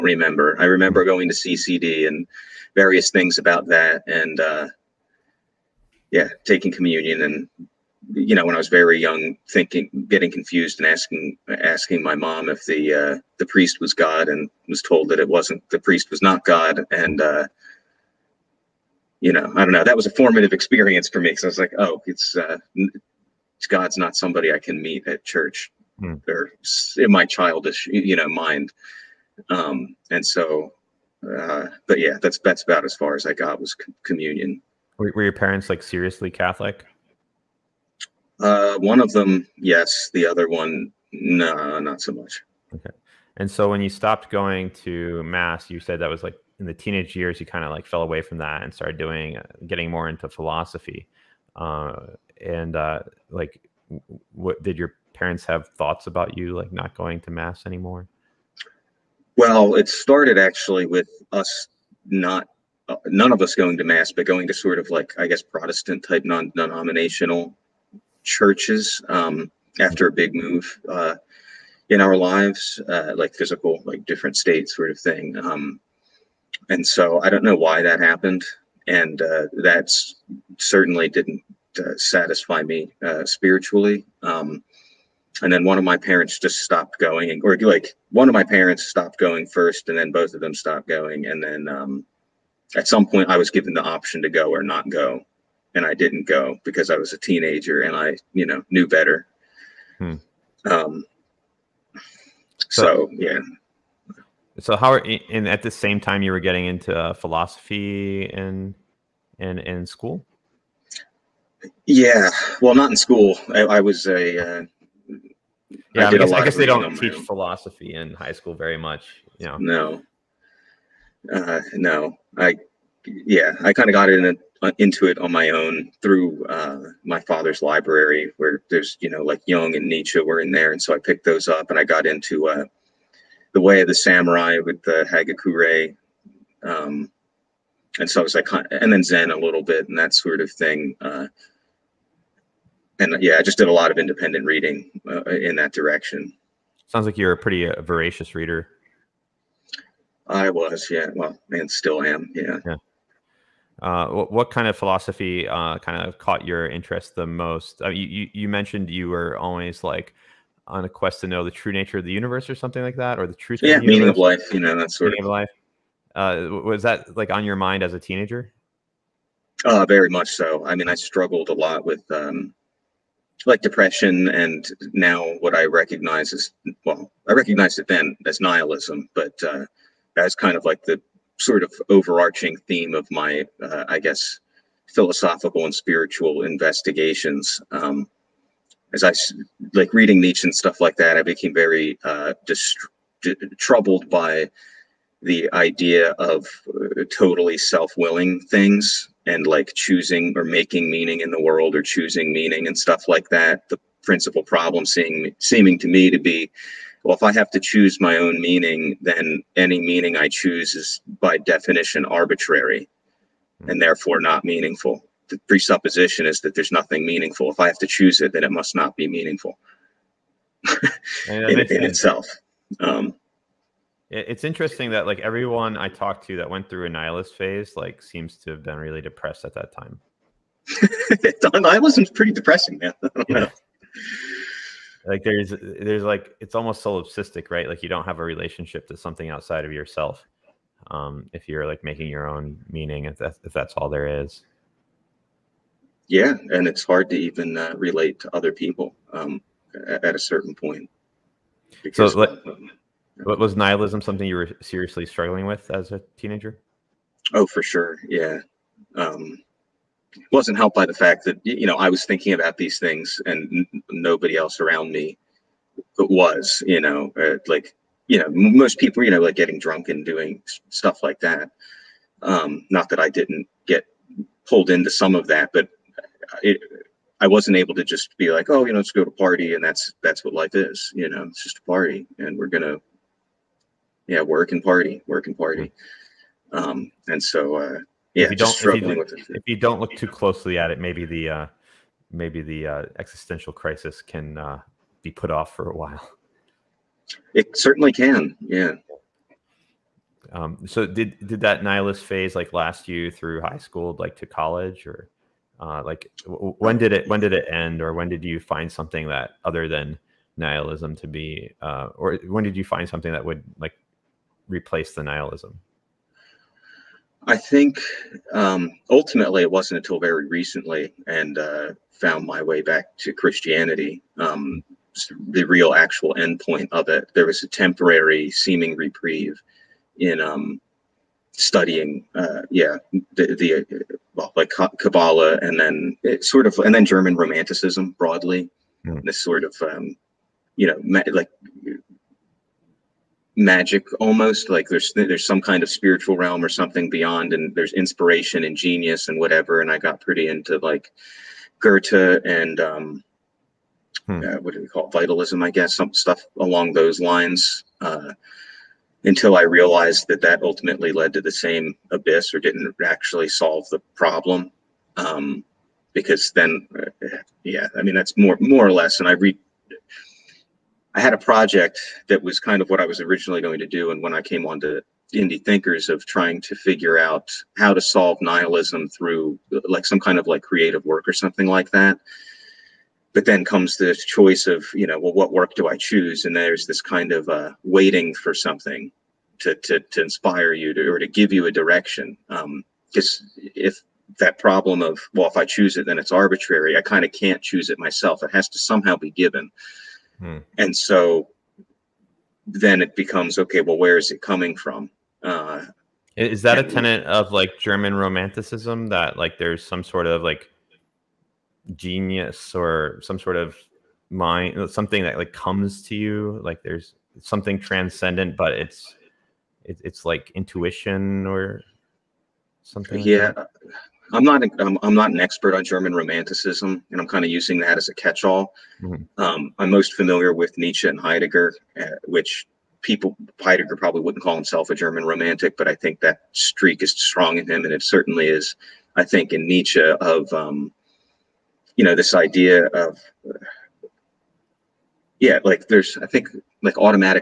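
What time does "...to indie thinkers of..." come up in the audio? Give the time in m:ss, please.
6:14.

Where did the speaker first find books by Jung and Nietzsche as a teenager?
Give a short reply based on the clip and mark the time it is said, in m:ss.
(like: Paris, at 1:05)
Father's library, at 2:07.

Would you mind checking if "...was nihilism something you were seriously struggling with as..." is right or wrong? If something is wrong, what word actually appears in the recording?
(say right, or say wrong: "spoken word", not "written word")
right.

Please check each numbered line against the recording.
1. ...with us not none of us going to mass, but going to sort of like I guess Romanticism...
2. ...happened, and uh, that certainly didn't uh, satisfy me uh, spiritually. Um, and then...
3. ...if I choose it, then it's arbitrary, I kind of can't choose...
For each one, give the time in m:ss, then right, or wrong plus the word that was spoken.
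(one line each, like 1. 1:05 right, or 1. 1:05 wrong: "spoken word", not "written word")
1. 1:00 wrong: "Protestant", not "Romanticism"
2. 1:17 right
3. 6:35 right.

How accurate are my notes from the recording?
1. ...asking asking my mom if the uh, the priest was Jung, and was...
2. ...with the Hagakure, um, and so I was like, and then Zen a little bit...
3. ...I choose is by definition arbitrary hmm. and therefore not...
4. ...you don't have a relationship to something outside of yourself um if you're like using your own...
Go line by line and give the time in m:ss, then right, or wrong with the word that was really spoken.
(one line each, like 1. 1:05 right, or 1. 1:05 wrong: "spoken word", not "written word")
1. 0:10 wrong: "God", not "Jung"
2. 2:14 right
3. 3:30 right
4. 3:57 wrong: "making", not "using".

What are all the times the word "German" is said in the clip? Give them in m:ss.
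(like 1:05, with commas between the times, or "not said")
5:36, 6:47, 7:05, 7:14.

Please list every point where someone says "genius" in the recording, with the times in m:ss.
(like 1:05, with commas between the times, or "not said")
5:48, 6:51.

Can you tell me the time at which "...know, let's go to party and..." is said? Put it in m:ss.
4:38.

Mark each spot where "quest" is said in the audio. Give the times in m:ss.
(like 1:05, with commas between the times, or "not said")
2:40.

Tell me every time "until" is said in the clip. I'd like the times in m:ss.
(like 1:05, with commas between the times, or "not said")
5:19, 5:59.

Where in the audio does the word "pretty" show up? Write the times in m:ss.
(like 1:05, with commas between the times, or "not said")
2:27, 3:52, 5:50.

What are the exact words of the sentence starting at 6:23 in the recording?
But then comes the choice of, you know, well, what work do I choose?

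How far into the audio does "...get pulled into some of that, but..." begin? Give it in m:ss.
4:33.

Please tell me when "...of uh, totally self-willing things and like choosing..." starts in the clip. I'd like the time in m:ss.
3:16.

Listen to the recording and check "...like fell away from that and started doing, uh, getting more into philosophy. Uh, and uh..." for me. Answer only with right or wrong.
right.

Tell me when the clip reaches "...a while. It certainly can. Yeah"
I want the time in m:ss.
4:55.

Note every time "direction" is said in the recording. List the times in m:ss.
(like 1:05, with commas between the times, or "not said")
2:25, 6:31.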